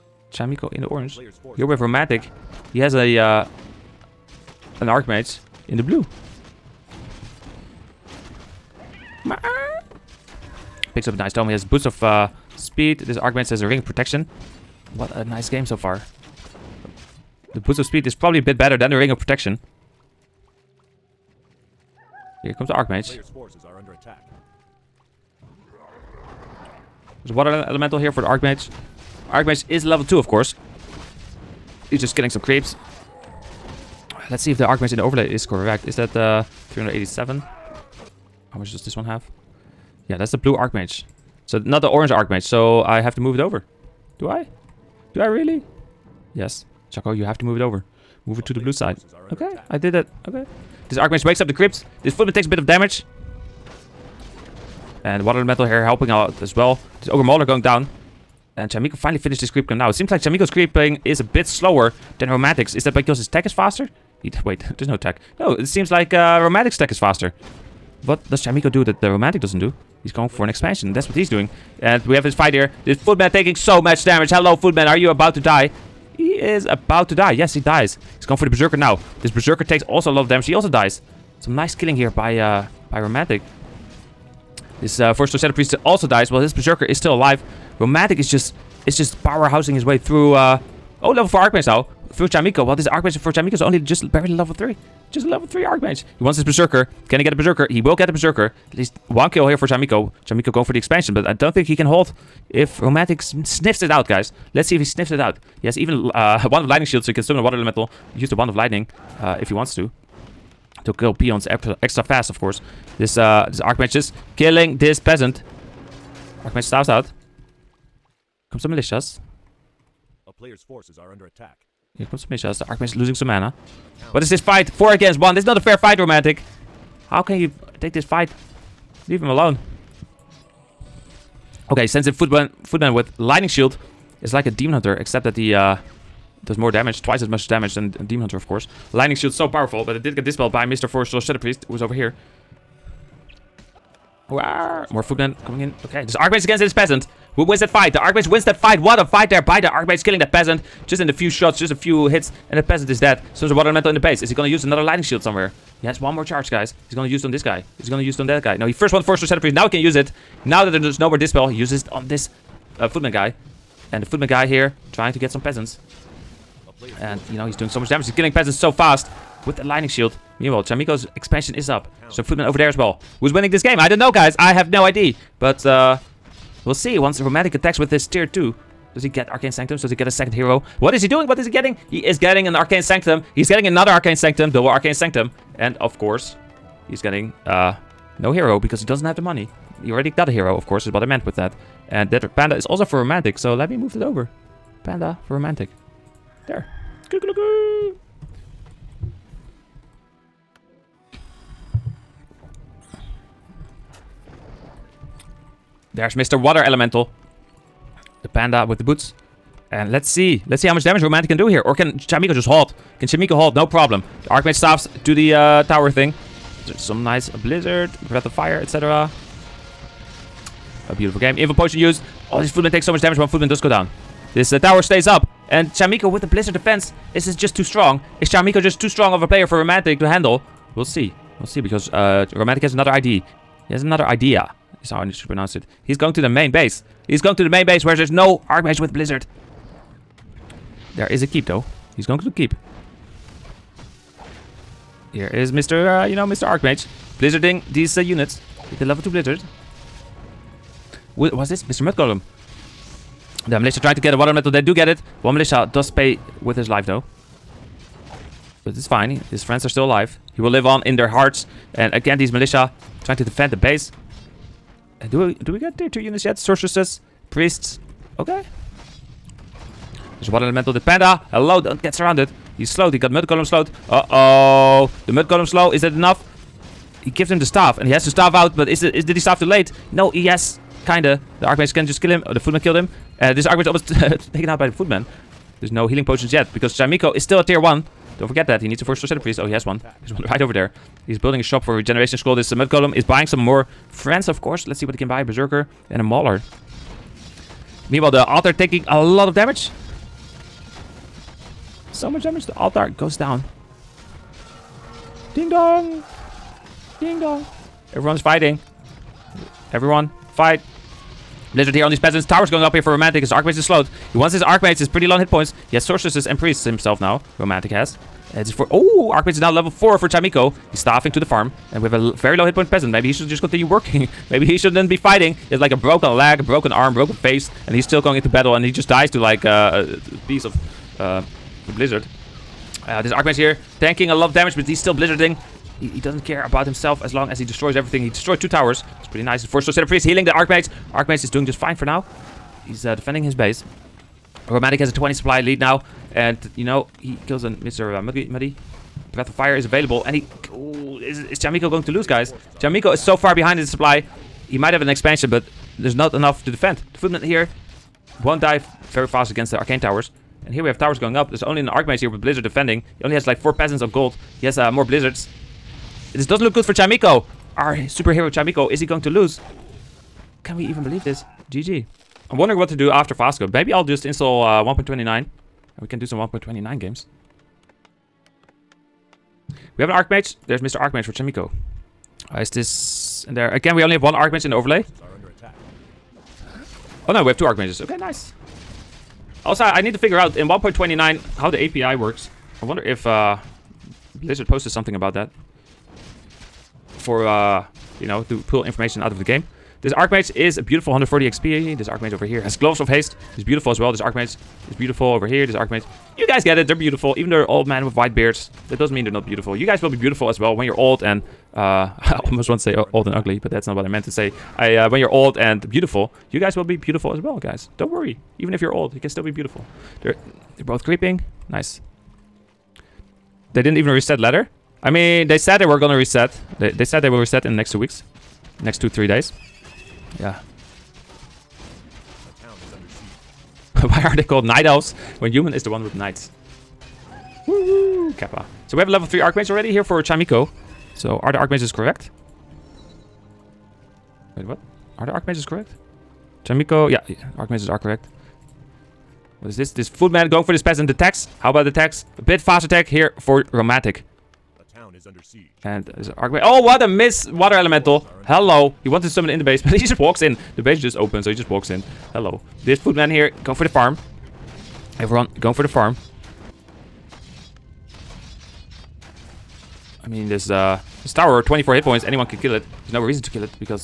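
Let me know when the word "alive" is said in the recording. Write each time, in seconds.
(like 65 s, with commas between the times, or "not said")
87 s, 259 s.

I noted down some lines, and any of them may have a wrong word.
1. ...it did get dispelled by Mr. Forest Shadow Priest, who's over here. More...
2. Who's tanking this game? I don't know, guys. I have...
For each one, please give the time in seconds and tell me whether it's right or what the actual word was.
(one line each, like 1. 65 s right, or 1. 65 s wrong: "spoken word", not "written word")
1. 139 s right
2. 173 s wrong: "winning", not "tanking".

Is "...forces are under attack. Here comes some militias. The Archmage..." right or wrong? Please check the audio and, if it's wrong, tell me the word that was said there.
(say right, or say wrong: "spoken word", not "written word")
right.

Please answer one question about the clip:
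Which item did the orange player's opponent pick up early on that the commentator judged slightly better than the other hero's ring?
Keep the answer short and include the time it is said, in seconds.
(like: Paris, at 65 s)
Boost of speed, at 11 s.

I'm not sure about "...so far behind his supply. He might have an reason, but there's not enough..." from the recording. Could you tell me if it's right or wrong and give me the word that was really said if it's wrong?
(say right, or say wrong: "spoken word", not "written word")
wrong: "expansion", not "reason".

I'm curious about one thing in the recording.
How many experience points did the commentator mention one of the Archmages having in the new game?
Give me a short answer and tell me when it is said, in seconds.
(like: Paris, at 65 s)
140, at 400 s.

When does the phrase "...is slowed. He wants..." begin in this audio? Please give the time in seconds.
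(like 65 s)
313 s.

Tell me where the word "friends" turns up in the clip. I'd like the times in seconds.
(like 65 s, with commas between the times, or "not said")
259 s, 293 s.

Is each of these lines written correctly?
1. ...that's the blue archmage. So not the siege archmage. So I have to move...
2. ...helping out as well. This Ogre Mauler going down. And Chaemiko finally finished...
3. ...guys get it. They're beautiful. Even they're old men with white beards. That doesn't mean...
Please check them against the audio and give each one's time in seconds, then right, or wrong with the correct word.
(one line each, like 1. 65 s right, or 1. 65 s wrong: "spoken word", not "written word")
1. 40 s wrong: "orange", not "siege"
2. 55 s right
3. 406 s right.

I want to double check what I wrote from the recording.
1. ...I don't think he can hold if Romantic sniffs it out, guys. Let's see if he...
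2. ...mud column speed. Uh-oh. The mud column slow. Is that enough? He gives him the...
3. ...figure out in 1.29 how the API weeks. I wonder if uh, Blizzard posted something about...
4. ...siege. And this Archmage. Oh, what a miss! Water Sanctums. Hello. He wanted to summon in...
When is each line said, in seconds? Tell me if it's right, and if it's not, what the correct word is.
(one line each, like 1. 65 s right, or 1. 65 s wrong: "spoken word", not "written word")
1. 101 s right
2. 273 s wrong: "slowed", not "speed"
3. 389 s wrong: "works", not "weeks"
4. 455 s wrong: "Elemental", not "Sanctums".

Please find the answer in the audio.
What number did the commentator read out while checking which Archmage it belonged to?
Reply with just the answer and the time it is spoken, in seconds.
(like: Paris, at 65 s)
387, at 36 s.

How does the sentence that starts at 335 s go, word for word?
He, he, doesn't care about himself as long as he destroys everything.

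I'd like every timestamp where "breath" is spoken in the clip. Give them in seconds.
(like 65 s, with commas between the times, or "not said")
218 s, 349 s.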